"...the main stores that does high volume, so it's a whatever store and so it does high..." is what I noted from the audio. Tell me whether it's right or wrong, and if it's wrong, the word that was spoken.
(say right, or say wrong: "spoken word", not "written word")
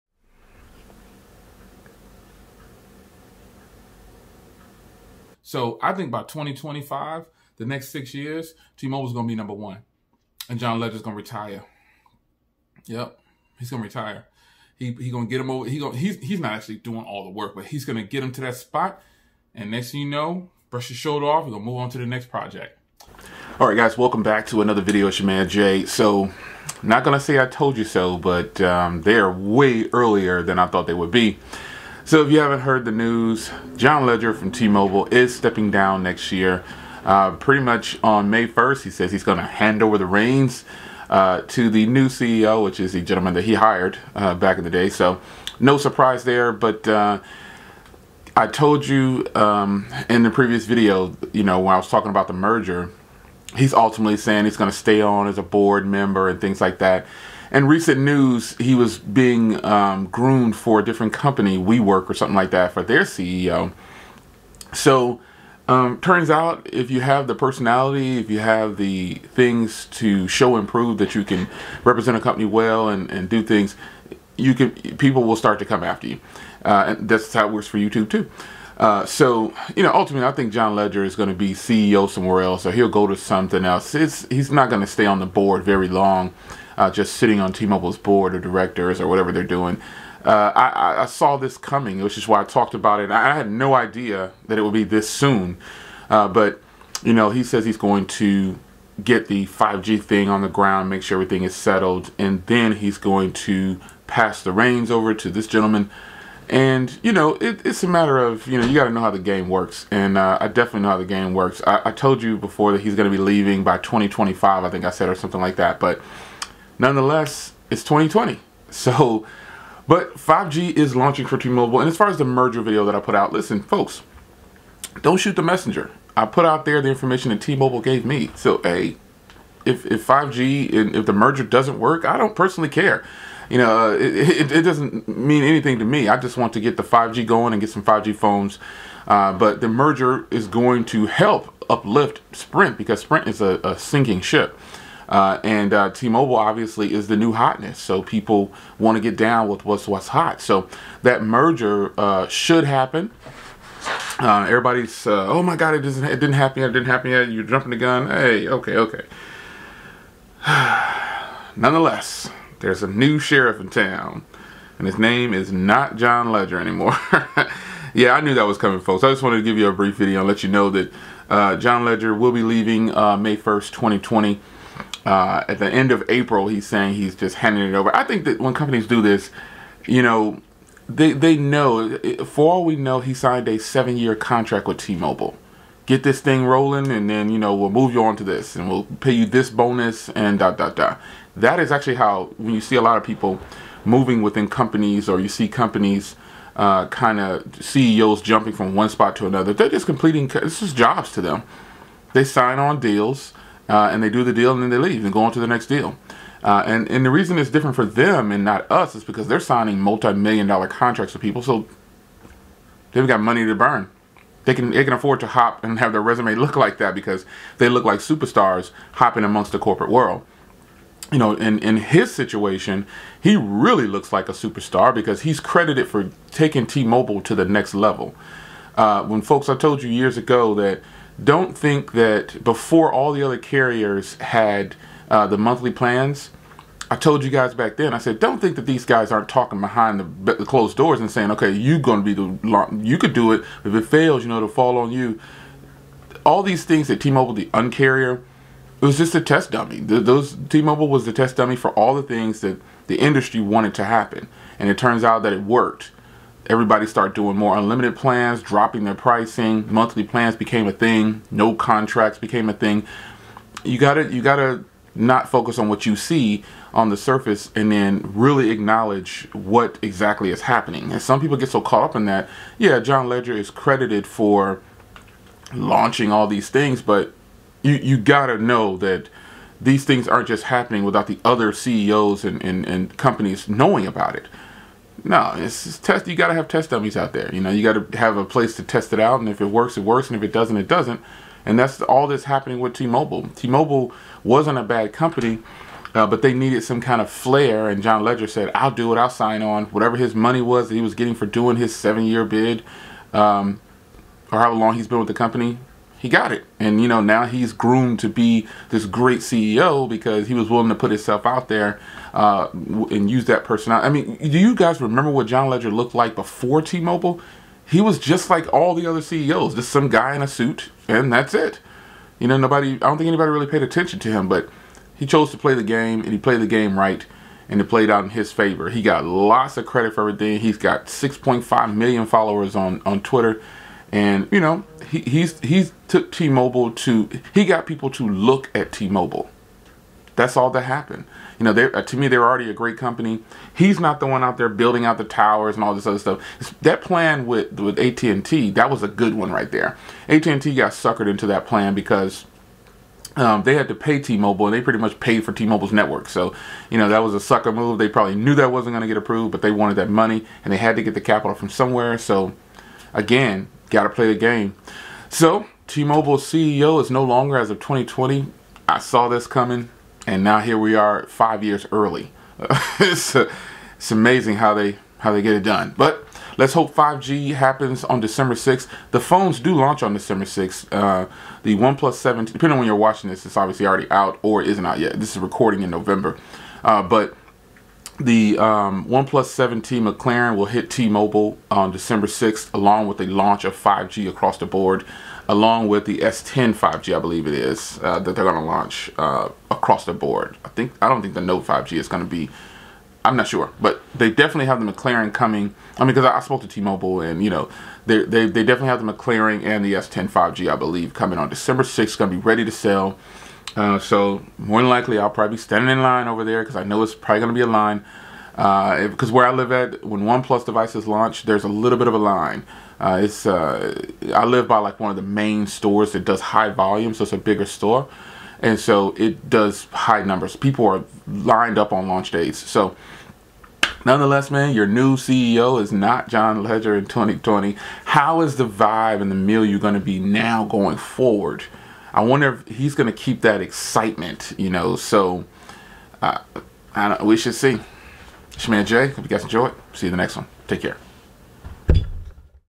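wrong: "bigger", not "whatever".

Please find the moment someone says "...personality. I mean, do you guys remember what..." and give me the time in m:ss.
5:13.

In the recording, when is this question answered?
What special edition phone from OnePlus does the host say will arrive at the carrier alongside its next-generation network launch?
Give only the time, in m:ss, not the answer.
6:28.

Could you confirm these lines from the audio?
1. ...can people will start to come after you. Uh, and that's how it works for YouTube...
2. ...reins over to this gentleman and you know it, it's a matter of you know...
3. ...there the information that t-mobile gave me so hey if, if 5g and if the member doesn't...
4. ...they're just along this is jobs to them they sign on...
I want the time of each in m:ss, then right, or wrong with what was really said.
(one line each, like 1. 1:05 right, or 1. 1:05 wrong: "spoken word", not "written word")
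1. 1:14 right
2. 1:44 right
3. 2:06 wrong: "merger", not "member"
4. 3:19 wrong: "completing", not "along".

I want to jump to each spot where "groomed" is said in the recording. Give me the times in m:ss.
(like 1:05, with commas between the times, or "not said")
1:00, 5:07.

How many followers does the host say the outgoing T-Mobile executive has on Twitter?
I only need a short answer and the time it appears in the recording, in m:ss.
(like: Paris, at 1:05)
6.5 million, at 5:30.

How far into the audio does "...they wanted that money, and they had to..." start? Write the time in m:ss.
5:59.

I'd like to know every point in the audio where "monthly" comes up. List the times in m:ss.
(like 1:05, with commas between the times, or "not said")
3:55, 4:19.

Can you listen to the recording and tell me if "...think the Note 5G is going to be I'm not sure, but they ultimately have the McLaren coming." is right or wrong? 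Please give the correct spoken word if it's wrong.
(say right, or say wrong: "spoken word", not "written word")
wrong: "definitely", not "ultimately".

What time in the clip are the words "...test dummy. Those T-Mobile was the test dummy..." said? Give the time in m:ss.
4:09.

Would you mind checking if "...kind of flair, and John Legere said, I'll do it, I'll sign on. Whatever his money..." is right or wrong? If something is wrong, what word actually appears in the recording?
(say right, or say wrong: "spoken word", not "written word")
right.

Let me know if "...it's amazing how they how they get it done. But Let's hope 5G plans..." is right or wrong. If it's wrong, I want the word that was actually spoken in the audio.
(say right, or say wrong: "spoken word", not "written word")
wrong: "happens", not "plans".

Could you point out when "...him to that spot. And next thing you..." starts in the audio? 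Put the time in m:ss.
0:18.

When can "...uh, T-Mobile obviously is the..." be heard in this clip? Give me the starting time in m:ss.
2:25.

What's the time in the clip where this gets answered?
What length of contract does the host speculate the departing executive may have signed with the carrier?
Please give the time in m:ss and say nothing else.
3:03.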